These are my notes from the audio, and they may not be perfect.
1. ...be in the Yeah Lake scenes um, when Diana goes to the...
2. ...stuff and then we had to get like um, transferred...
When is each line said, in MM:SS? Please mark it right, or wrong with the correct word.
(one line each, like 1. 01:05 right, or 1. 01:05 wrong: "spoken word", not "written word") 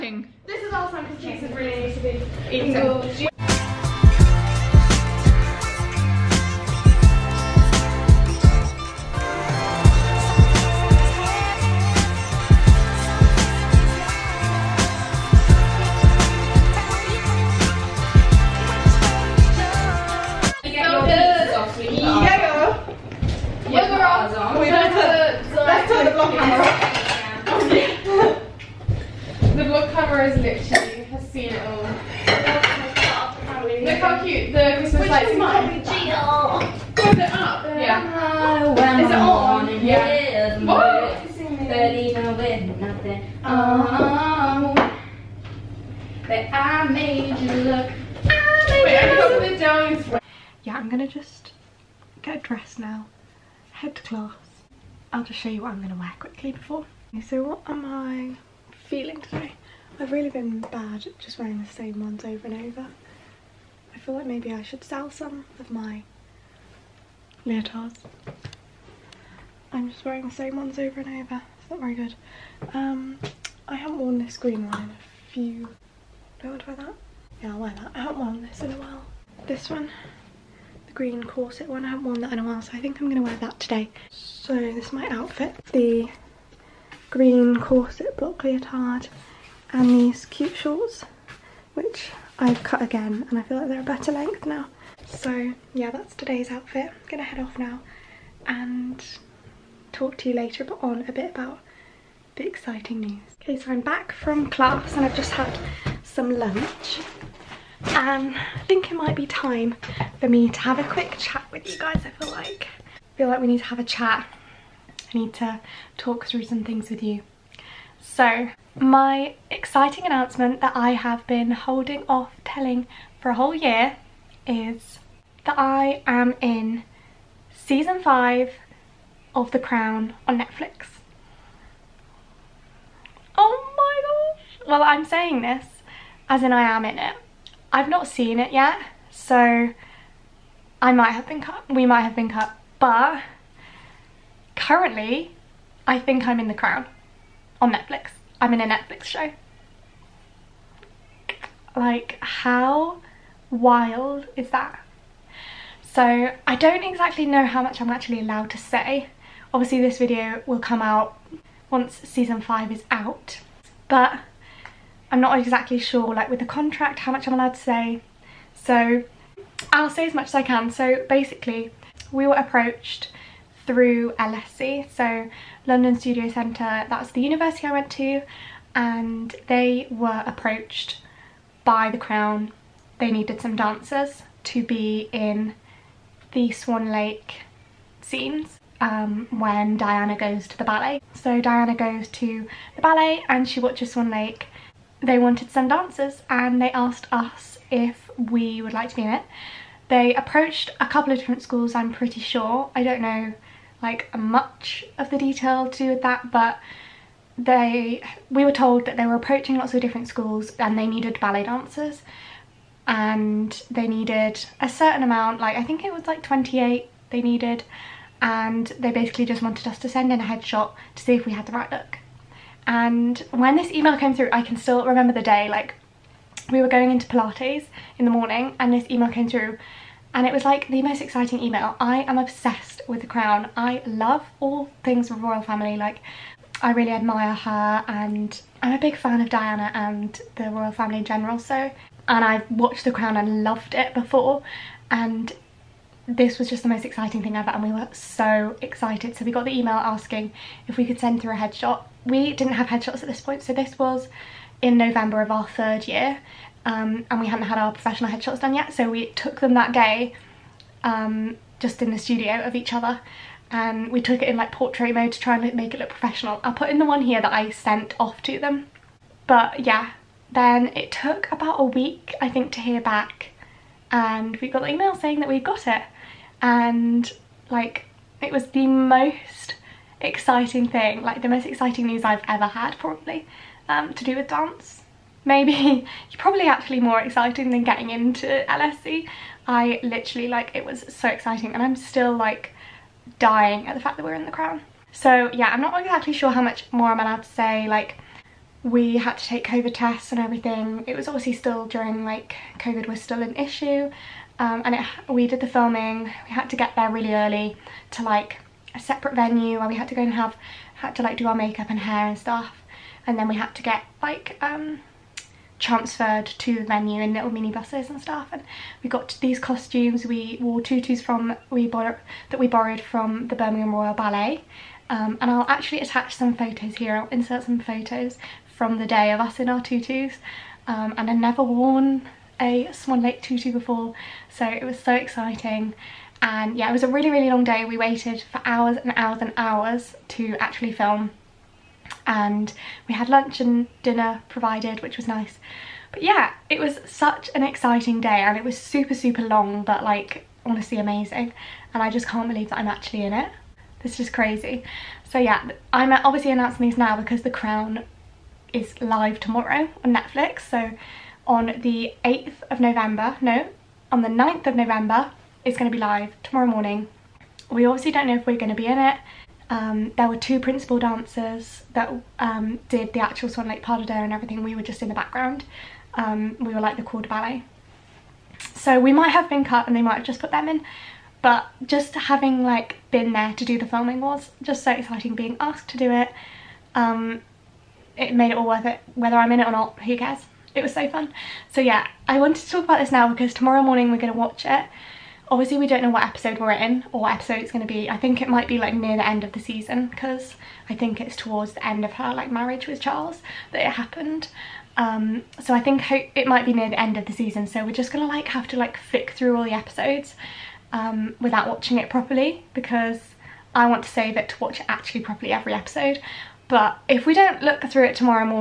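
1. 03:04 wrong: "Swan", not "Yeah"
2. 05:12 right.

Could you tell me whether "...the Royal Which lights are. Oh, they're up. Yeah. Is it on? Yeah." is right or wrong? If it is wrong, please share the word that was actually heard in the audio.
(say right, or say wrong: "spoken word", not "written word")
wrong: "Christmas", not "Royal".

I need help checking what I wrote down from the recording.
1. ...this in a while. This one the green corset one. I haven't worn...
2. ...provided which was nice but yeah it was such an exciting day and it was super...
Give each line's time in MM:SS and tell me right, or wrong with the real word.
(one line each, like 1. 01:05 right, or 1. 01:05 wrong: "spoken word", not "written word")
1. 01:18 right
2. 05:44 right.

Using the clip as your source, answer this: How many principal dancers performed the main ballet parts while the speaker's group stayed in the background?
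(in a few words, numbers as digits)
2.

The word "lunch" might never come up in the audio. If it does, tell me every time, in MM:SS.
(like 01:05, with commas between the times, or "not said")
01:46, 05:43.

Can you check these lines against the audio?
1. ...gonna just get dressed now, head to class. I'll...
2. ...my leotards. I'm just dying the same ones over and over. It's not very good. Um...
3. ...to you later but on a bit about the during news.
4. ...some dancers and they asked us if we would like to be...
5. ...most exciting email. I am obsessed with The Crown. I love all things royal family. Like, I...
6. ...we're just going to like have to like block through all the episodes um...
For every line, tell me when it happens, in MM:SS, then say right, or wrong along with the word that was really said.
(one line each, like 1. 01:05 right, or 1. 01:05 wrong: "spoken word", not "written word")
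1. 00:50 right
2. 01:05 wrong: "wearing", not "dying"
3. 01:40 wrong: "exciting", not "during"
4. 03:15 right
5. 03:50 right
6. 06:47 wrong: "flick", not "block".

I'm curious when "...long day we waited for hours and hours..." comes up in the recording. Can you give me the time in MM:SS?
05:37.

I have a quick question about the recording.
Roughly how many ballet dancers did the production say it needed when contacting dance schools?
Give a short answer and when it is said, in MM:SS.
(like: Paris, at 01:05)
28, at 03:36.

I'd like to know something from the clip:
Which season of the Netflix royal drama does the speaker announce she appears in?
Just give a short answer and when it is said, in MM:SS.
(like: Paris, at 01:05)
5, at 02:07.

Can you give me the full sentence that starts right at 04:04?
And this was just the most exciting thing ever and we were so excited.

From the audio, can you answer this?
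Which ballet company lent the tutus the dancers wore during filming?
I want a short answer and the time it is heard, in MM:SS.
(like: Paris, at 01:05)
Birmingham Royal Ballet, at 05:23.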